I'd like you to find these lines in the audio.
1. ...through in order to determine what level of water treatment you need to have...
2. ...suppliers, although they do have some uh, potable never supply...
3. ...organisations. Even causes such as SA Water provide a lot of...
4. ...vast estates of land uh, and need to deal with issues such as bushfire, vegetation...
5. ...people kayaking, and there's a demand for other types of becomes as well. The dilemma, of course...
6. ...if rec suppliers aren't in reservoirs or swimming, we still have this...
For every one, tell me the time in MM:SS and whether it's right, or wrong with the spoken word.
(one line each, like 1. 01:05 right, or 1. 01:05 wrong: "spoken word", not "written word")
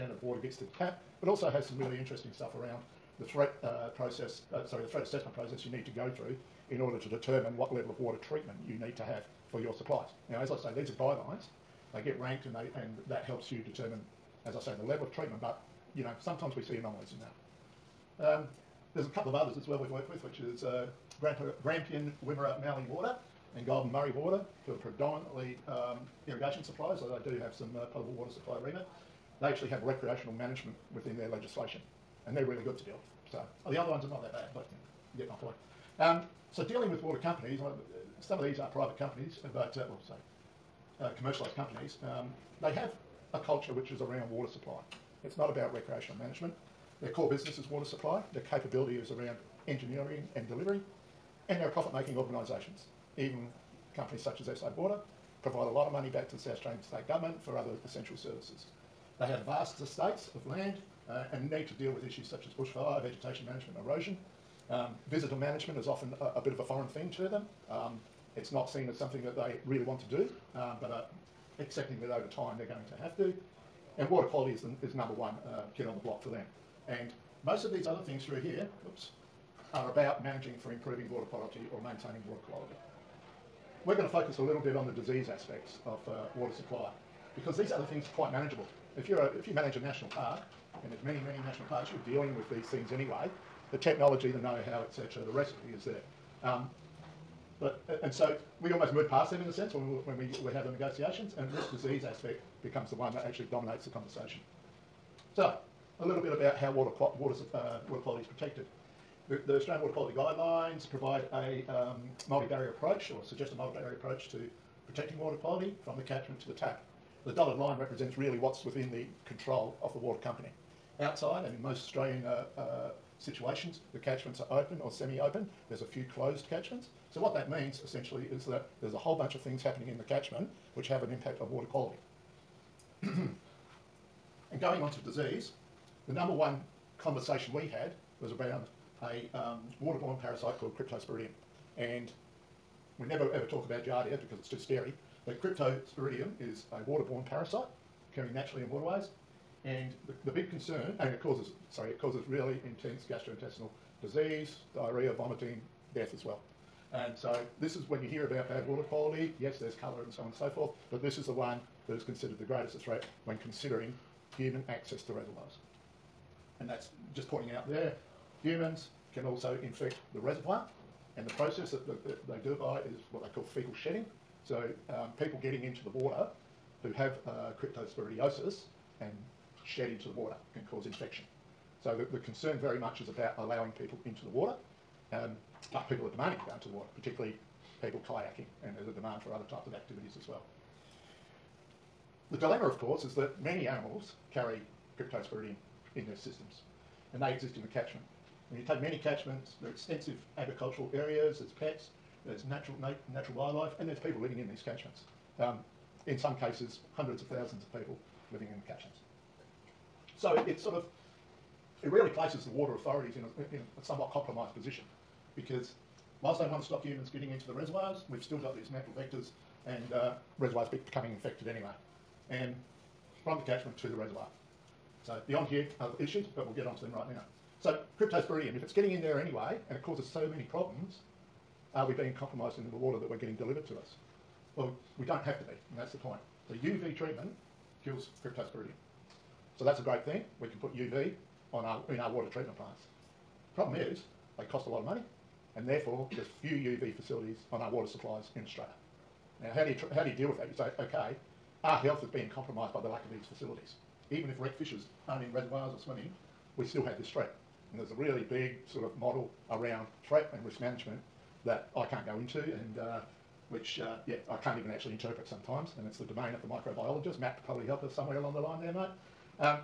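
1. 00:06 right
2. 00:26 wrong: "water", not "never"
3. 00:52 wrong: "companies", not "causes"
4. 00:59 right
5. 03:07 wrong: "activities", not "becomes"
6. 04:14 wrong: "fishers", not "suppliers".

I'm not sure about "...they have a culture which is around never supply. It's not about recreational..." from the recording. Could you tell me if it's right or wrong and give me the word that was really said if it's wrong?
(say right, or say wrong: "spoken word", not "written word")
wrong: "water", not "never".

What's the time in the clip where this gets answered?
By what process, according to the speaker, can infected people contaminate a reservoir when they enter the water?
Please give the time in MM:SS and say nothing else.
02:53.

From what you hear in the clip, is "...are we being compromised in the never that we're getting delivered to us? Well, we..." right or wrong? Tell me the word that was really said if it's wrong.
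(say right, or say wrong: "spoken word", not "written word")
wrong: "water", not "never".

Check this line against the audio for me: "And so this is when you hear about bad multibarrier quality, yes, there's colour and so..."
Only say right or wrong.
wrong.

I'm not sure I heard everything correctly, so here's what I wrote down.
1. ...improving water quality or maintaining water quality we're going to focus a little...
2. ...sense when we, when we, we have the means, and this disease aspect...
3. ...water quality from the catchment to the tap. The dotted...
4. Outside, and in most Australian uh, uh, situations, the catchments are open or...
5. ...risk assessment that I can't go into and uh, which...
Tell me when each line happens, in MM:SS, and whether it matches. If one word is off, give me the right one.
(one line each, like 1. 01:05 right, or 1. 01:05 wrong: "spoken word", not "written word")
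1. 01:20 right
2. 01:39 wrong: "negotiations", not "means"
3. 01:55 right
4. 02:00 right
5. 04:20 wrong: "management", not "assessment".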